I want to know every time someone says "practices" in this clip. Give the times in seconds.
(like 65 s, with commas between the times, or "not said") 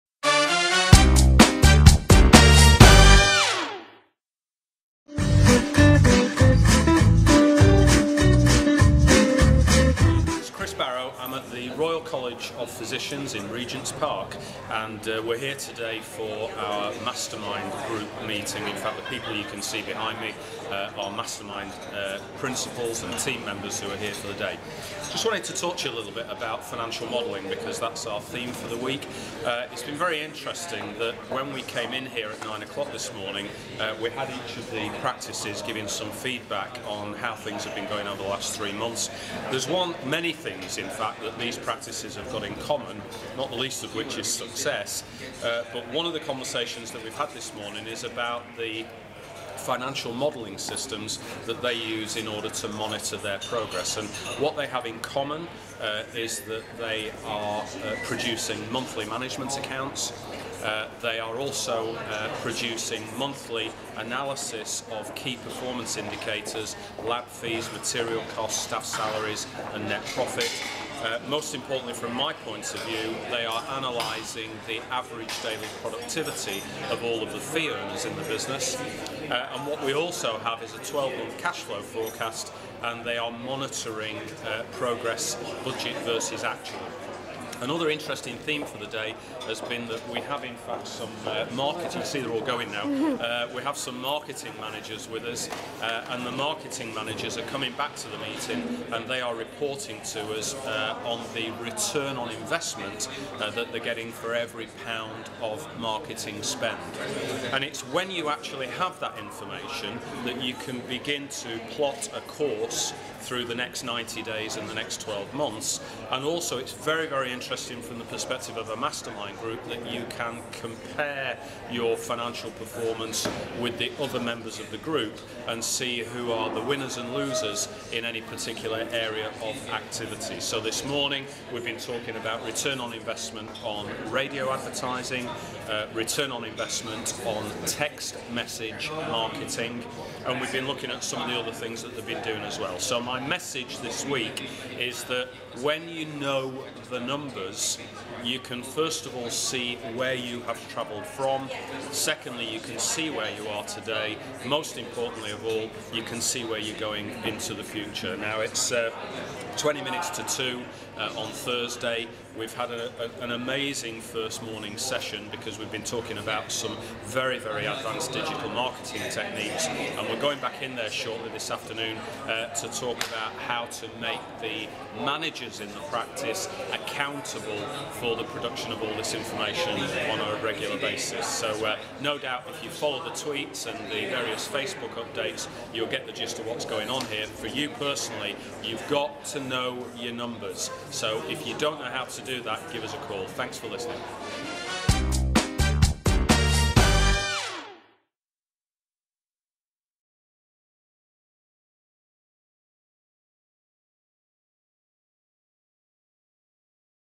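35 s, 41 s, 175 s.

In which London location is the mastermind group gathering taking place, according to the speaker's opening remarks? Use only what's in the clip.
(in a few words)
Regent's Park.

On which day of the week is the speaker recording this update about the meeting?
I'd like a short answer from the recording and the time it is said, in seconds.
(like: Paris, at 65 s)
Thursday, at 161 s.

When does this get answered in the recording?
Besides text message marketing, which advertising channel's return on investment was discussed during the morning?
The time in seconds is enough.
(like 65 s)
134 s.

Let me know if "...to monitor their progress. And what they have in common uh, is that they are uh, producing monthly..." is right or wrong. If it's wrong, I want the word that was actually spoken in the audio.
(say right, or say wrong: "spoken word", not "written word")
right.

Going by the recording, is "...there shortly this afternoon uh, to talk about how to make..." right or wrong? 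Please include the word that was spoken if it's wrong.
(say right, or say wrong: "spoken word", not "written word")
right.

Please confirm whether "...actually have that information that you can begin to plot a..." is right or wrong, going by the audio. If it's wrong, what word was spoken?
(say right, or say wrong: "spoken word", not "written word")
right.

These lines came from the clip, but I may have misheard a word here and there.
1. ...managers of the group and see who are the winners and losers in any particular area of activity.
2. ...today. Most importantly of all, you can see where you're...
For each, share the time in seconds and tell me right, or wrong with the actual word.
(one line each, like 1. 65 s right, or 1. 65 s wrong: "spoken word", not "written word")
1. 124 s wrong: "members", not "managers"
2. 153 s right.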